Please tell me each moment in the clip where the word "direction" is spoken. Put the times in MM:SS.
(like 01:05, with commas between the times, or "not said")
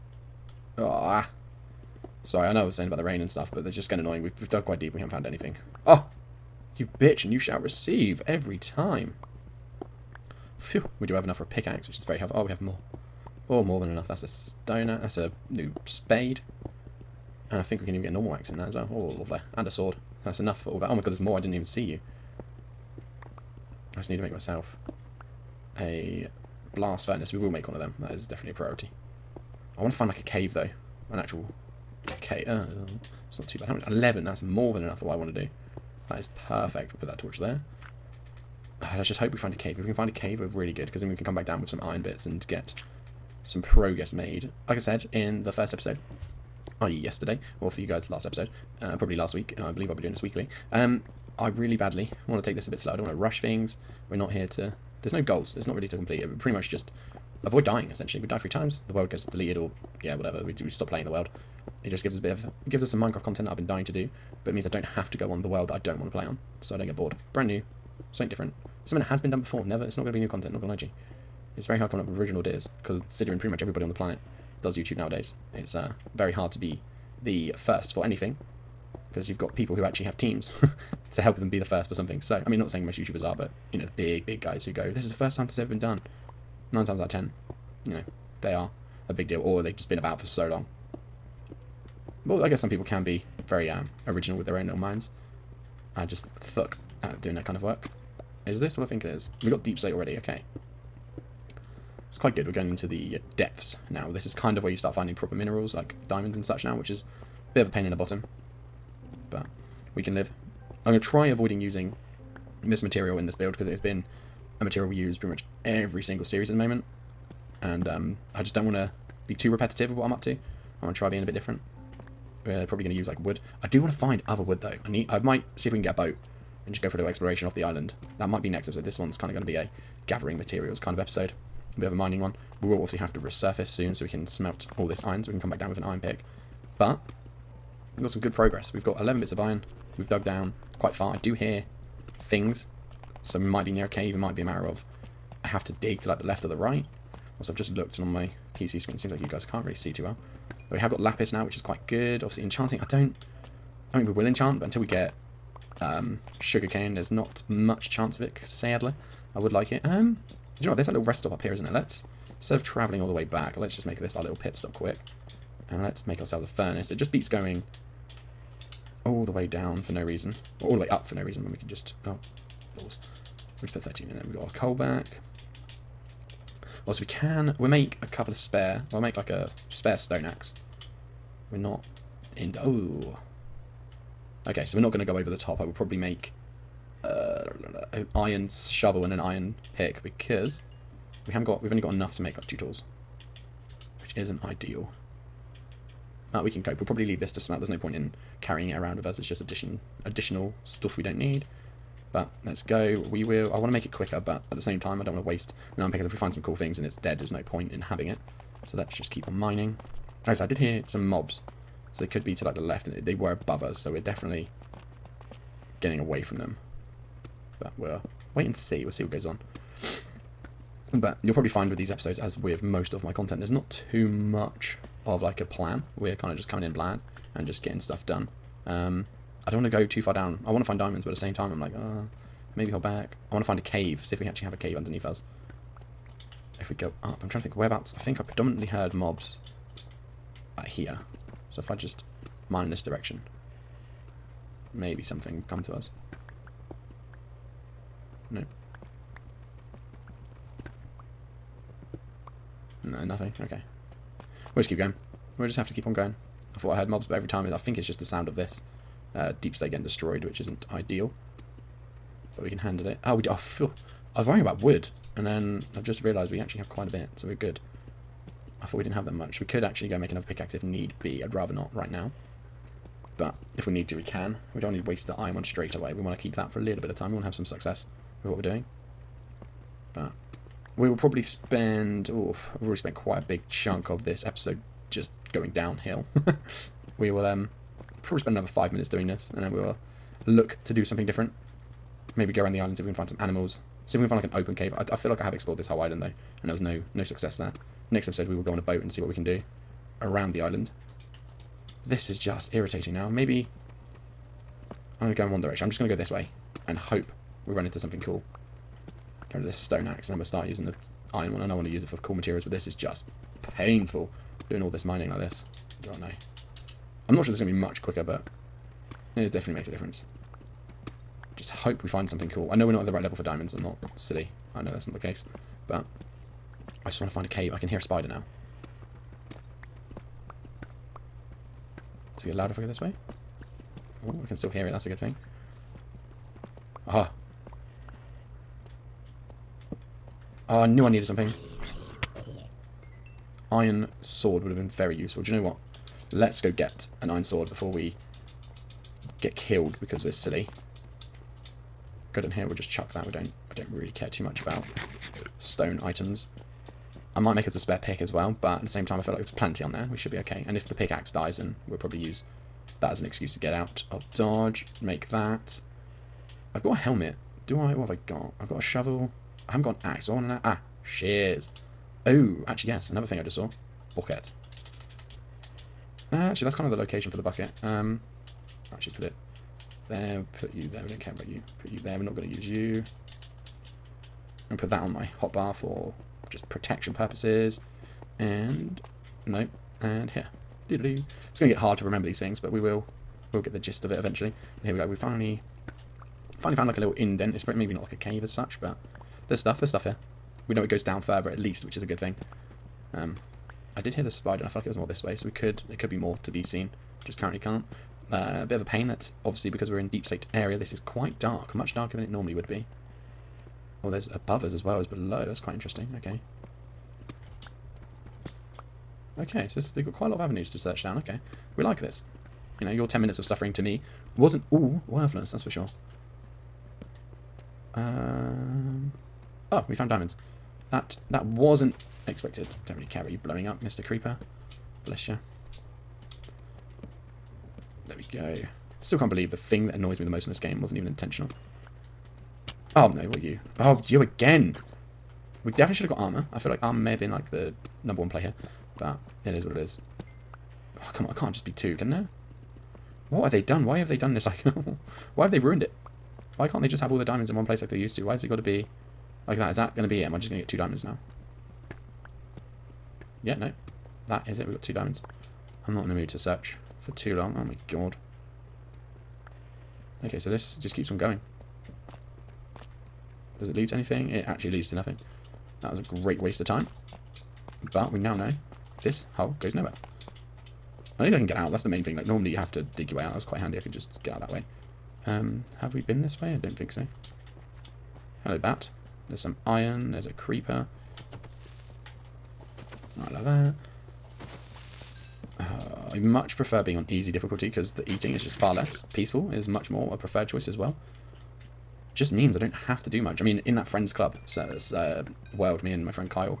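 04:02, 05:05.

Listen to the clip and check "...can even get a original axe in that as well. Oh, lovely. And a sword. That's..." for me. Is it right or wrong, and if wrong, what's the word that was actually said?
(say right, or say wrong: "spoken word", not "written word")
wrong: "normal", not "original".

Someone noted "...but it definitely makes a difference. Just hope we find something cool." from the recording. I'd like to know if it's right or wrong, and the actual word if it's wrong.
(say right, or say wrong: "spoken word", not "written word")
right.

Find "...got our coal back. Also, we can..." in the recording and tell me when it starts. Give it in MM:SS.
02:54.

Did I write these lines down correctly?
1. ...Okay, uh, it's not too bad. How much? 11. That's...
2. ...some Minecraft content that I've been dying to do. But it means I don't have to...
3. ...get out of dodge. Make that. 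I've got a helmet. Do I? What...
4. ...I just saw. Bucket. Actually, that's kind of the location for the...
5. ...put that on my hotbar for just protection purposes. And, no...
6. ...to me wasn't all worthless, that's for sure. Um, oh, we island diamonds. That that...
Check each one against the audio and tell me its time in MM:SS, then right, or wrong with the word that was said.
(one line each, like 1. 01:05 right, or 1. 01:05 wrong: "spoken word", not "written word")
1. 00:32 right
2. 01:02 right
3. 06:03 right
4. 06:13 right
5. 06:24 right
6. 07:03 wrong: "found", not "island".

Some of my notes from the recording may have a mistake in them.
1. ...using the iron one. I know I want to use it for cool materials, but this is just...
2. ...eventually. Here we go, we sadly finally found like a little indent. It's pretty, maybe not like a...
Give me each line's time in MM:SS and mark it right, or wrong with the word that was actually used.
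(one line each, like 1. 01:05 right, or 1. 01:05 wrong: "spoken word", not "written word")
1. 05:10 right
2. 06:33 wrong: "finally", not "sadly".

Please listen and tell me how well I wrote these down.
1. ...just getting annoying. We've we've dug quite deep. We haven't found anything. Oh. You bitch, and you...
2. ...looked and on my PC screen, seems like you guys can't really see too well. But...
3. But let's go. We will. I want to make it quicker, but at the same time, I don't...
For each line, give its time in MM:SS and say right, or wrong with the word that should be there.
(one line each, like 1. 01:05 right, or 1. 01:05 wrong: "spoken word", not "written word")
1. 00:03 right
2. 02:27 right
3. 03:22 right.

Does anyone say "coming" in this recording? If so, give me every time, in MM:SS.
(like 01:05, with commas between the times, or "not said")
01:11, 03:46.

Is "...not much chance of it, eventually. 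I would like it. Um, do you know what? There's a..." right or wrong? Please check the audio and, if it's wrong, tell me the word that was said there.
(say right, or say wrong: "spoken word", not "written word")
wrong: "sadly", not "eventually".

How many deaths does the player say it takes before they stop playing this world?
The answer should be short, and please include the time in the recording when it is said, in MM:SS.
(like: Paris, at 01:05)
3, at 00:58.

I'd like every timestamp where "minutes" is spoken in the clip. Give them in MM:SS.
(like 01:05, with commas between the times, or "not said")
04:48, 07:03.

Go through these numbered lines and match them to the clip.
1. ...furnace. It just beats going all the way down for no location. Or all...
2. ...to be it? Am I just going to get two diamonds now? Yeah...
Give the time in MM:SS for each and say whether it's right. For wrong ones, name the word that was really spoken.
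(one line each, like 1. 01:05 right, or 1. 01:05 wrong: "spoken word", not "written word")
1. 02:46 wrong: "reason", not "location"
2. 07:39 right.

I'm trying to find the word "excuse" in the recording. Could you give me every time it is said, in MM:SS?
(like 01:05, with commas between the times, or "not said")
06:03.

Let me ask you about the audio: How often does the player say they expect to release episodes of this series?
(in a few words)
Weekly.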